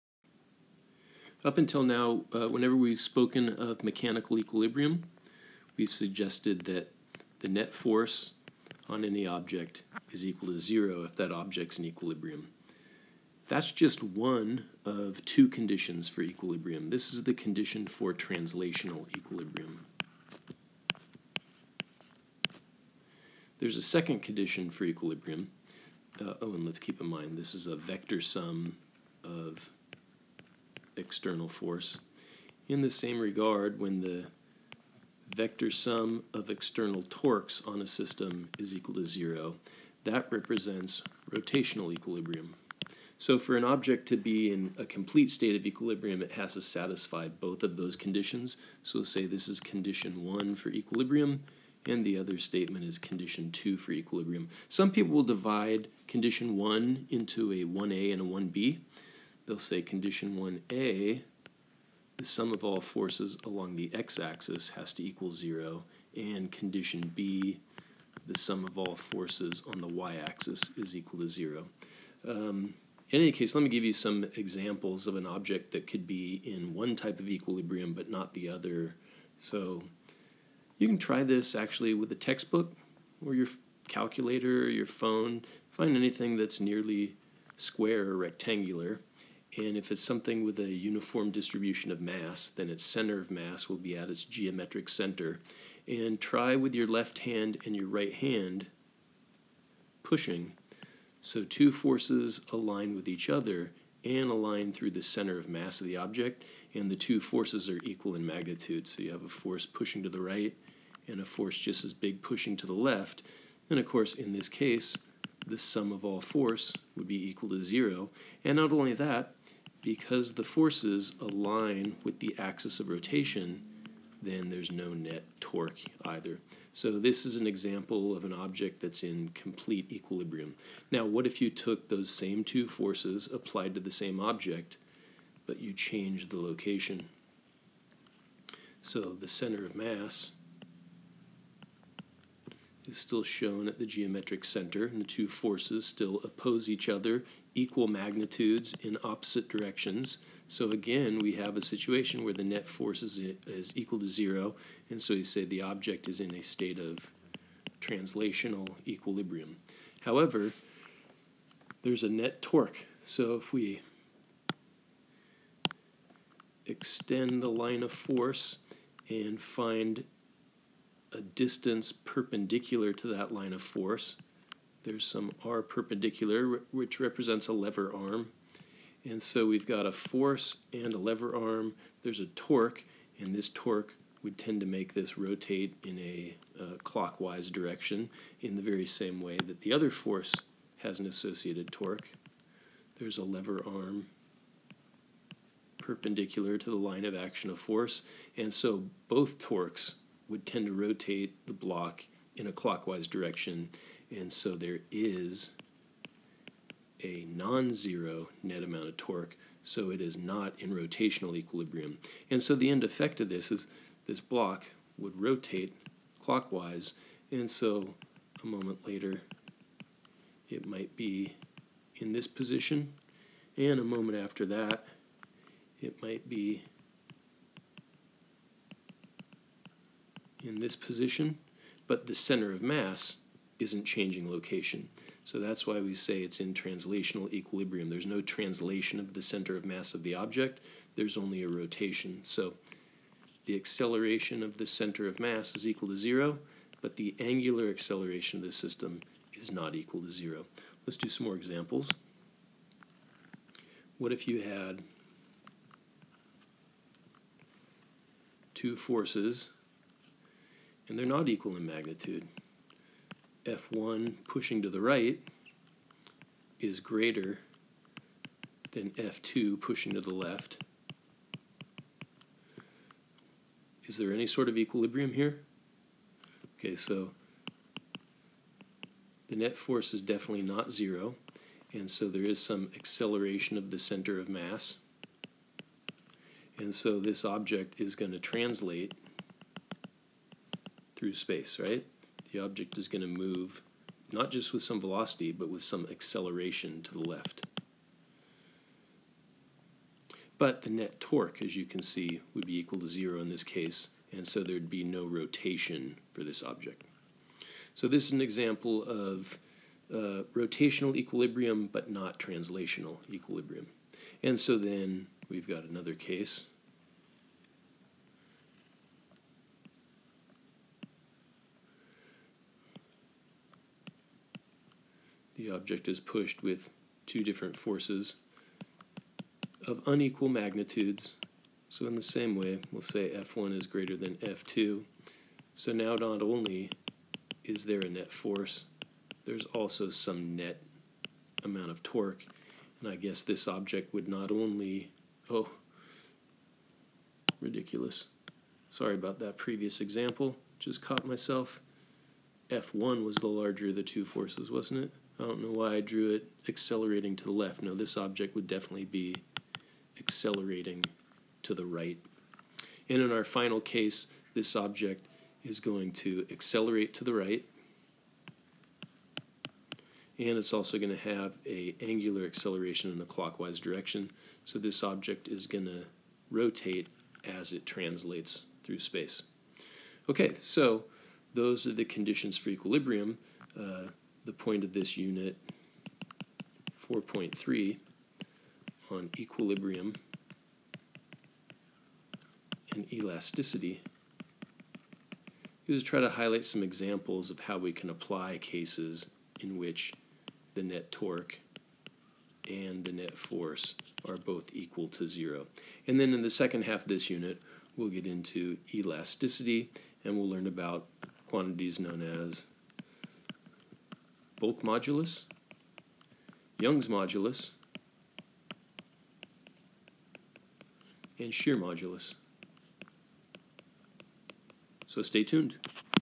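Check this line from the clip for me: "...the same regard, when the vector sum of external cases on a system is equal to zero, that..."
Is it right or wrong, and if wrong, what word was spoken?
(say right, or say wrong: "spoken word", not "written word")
wrong: "torques", not "cases".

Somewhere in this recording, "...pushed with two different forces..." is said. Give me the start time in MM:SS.
05:25.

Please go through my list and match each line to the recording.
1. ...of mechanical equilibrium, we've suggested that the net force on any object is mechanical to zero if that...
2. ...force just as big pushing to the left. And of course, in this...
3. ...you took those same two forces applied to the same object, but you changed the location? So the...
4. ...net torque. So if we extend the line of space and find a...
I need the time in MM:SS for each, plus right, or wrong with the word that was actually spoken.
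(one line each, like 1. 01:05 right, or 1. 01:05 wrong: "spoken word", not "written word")
1. 00:03 wrong: "equal", not "mechanical"
2. 01:51 right
3. 02:11 right
4. 02:42 wrong: "force", not "space".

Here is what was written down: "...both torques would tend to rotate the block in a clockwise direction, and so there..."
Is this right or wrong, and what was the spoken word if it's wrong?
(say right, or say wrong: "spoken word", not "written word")
right.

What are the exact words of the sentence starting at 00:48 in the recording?
So say this is condition one for equilibrium, and the other statement is condition two for equilibrium.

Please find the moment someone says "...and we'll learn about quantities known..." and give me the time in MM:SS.
06:50.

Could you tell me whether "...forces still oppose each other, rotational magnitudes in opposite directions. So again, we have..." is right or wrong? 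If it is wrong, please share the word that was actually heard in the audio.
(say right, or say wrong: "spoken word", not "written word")
wrong: "equal", not "rotational".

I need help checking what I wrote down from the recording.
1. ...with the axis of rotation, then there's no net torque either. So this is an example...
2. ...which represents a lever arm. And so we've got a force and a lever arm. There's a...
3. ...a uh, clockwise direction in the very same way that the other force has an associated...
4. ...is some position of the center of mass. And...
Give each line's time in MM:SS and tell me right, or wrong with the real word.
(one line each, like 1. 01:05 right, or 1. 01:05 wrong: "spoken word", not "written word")
1. 02:02 right
2. 02:56 right
3. 03:05 right
4. 04:42 wrong: "acceleration", not "position".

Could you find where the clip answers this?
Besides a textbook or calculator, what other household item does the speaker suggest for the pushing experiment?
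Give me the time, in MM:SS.
01:24.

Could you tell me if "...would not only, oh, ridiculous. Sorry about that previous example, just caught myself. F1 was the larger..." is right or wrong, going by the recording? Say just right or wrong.
right.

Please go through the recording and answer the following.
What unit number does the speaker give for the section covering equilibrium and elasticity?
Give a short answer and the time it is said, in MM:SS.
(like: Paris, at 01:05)
4.3, at 06:26.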